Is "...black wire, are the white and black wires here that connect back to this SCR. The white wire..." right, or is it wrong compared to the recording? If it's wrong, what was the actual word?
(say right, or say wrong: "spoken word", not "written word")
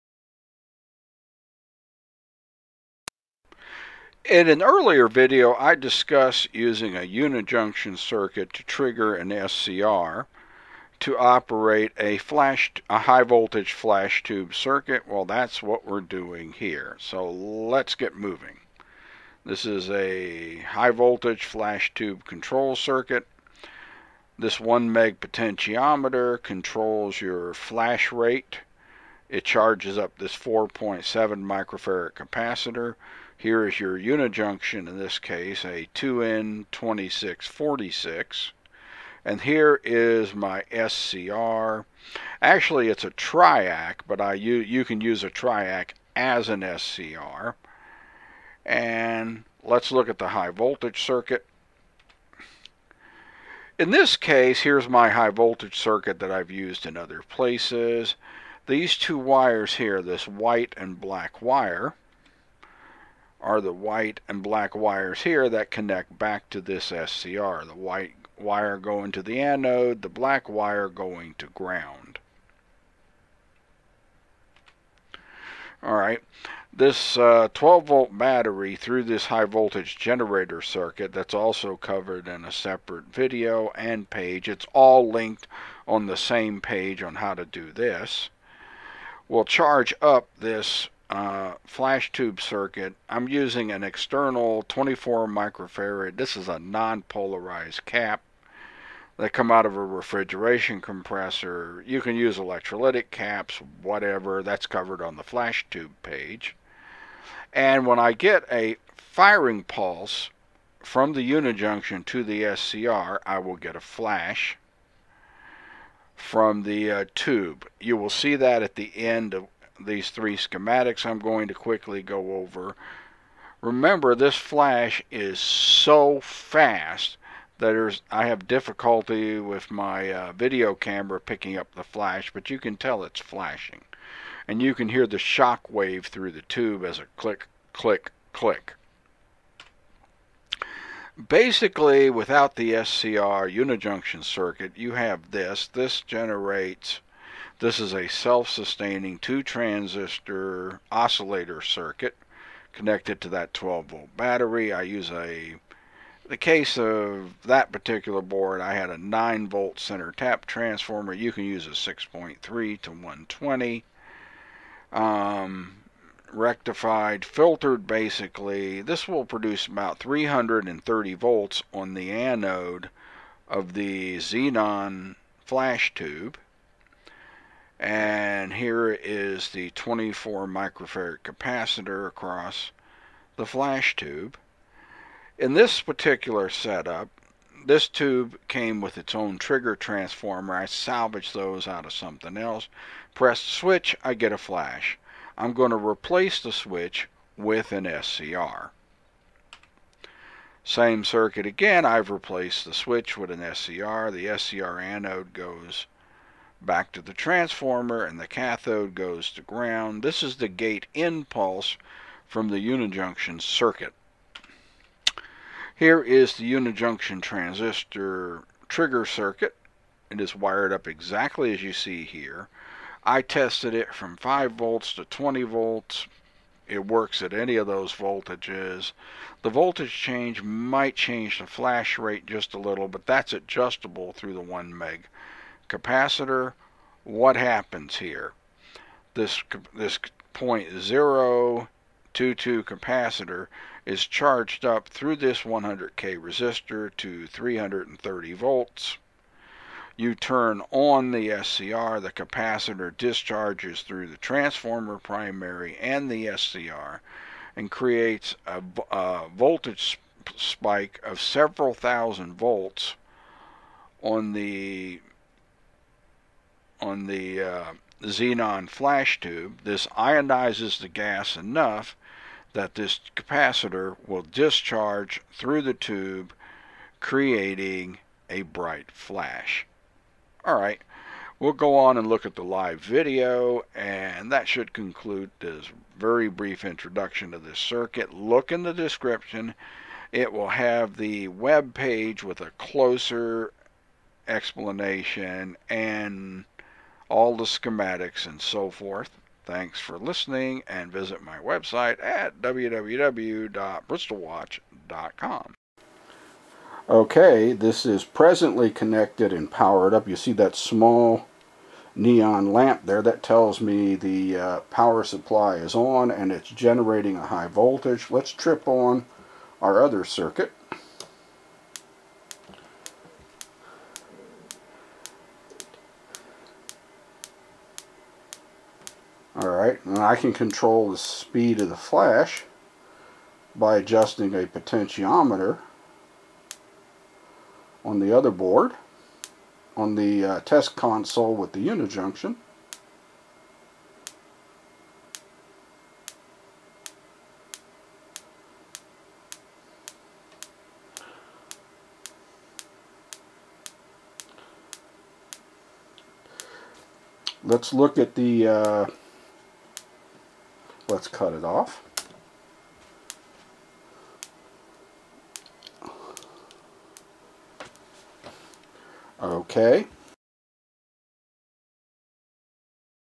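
right.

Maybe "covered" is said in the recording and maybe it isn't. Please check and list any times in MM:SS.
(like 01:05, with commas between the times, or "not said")
01:21, 01:44.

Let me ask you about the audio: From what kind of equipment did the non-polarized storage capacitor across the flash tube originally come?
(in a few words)
refrigeration compressor.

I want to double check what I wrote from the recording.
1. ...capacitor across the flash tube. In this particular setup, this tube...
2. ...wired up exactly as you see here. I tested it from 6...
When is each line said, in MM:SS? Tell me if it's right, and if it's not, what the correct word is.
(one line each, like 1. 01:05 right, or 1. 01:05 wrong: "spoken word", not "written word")
1. 03:01 right
2. 03:40 wrong: "5", not "6".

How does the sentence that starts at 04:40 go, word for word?
All right, we'll go on and look at the live video, and that should conclude this very brief introduction to this circuit.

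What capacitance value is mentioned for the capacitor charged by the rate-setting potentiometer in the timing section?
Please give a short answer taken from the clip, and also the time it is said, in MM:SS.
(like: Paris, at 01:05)
4.7 microfarad, at 00:30.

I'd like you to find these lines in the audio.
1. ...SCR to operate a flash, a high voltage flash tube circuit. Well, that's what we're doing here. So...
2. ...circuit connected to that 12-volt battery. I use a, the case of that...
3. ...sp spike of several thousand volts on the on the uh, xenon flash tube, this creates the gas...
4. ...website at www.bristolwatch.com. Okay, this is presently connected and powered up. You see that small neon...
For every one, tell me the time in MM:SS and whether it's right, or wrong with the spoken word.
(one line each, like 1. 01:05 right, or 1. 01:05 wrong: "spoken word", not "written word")
1. 00:09 right
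2. 02:31 right
3. 04:19 wrong: "ionizes", not "creates"
4. 05:01 right.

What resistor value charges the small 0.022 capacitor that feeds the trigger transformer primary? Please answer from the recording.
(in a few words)
100K.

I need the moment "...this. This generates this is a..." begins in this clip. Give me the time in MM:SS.
02:25.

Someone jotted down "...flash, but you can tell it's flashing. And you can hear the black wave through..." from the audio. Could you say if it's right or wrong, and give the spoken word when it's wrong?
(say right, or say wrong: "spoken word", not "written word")
wrong: "shock", not "black".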